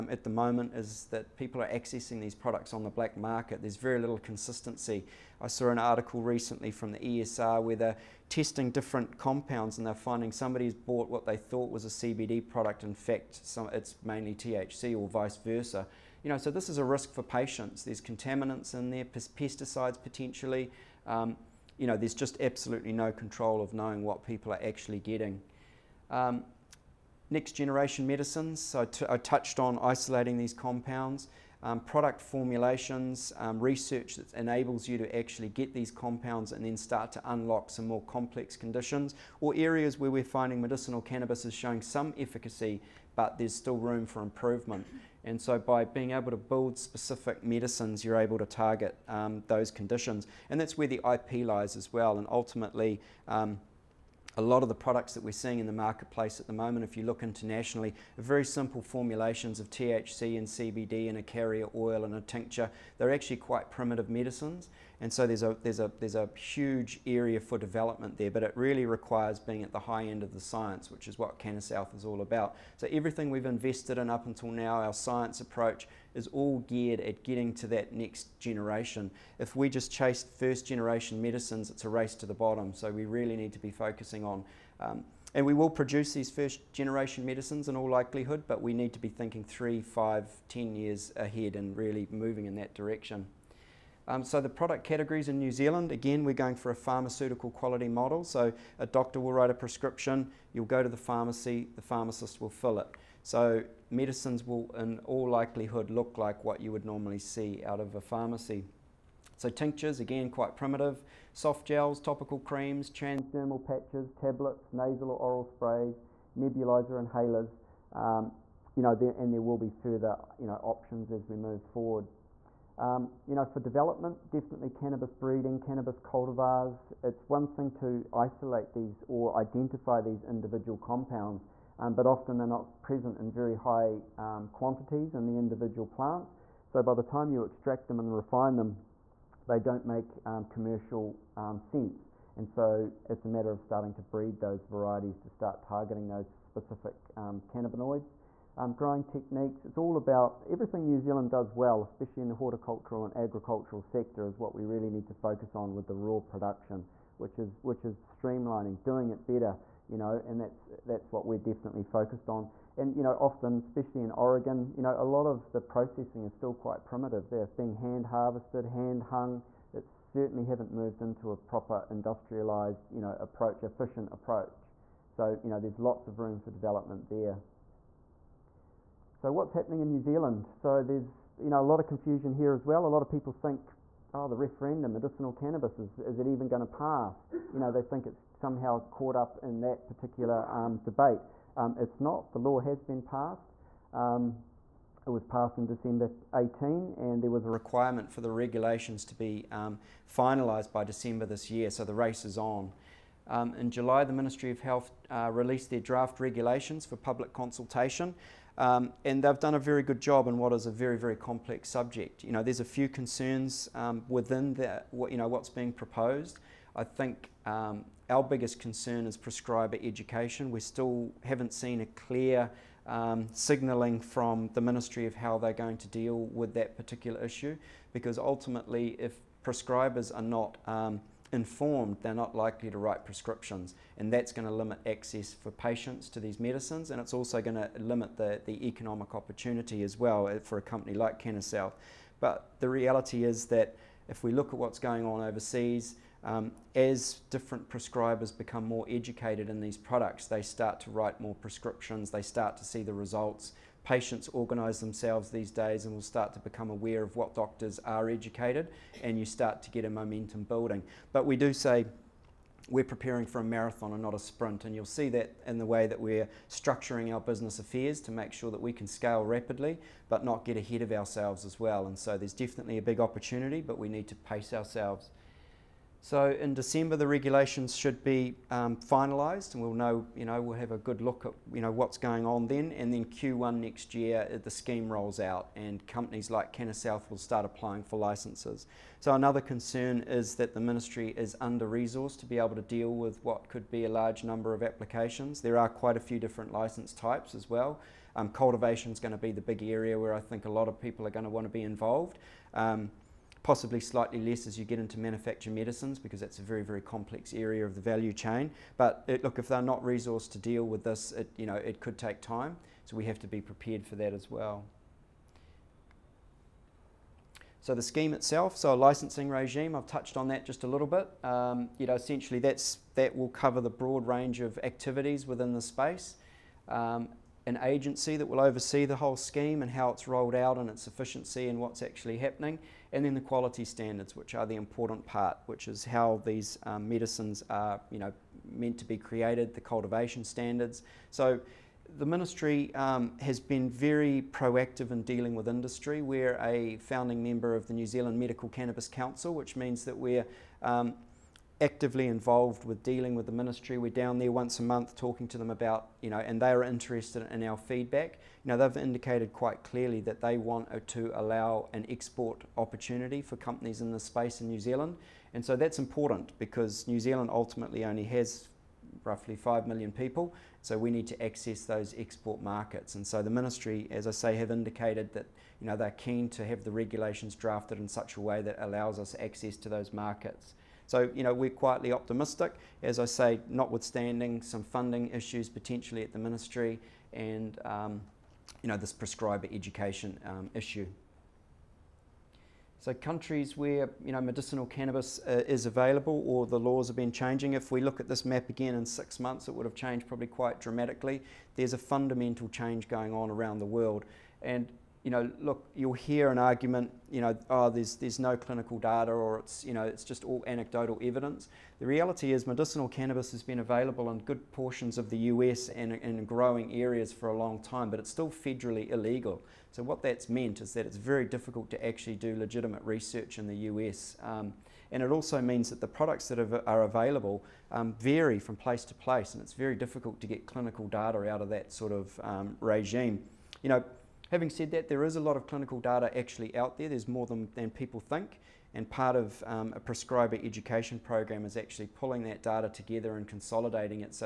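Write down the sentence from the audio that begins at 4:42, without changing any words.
And then Q1 next year, uh, the scheme rolls out, and companies like Cannasouth will start applying for licences.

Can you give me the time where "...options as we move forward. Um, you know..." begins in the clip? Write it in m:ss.
2:00.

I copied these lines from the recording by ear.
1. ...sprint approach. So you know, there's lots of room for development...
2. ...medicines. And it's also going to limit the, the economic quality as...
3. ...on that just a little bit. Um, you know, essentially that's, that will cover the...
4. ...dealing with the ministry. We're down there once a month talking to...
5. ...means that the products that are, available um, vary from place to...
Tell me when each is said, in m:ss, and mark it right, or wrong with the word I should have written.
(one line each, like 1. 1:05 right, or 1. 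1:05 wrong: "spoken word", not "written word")
1. 2:53 wrong: "efficient", not "sprint"
2. 3:56 wrong: "opportunity", not "quality"
3. 5:20 right
4. 5:52 right
5. 7:05 right.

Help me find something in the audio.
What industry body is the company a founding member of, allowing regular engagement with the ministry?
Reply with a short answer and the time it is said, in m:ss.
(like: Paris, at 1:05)
New Zealand Medical Cannabis Council, at 5:47.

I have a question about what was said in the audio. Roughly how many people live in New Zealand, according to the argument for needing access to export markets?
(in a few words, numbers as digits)
5 million.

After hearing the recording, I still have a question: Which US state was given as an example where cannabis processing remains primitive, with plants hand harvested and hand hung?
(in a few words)
Oregon.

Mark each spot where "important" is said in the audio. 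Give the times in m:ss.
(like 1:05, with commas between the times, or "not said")
5:34, 6:05.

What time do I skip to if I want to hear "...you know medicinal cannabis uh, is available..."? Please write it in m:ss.
6:34.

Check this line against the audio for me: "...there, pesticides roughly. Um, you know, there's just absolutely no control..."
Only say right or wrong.
wrong.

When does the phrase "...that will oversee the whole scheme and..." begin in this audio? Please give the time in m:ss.
5:28.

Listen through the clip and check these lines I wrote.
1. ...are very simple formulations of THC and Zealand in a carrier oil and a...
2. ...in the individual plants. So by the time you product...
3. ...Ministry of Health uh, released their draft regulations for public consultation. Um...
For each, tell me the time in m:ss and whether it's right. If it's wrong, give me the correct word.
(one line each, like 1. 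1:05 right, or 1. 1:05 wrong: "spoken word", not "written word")
1. 0:58 wrong: "CBD", not "Zealand"
2. 2:15 wrong: "extract", not "product"
3. 3:24 right.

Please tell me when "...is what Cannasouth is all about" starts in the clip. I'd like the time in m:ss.
1:11.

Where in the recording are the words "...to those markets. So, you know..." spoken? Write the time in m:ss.
6:19.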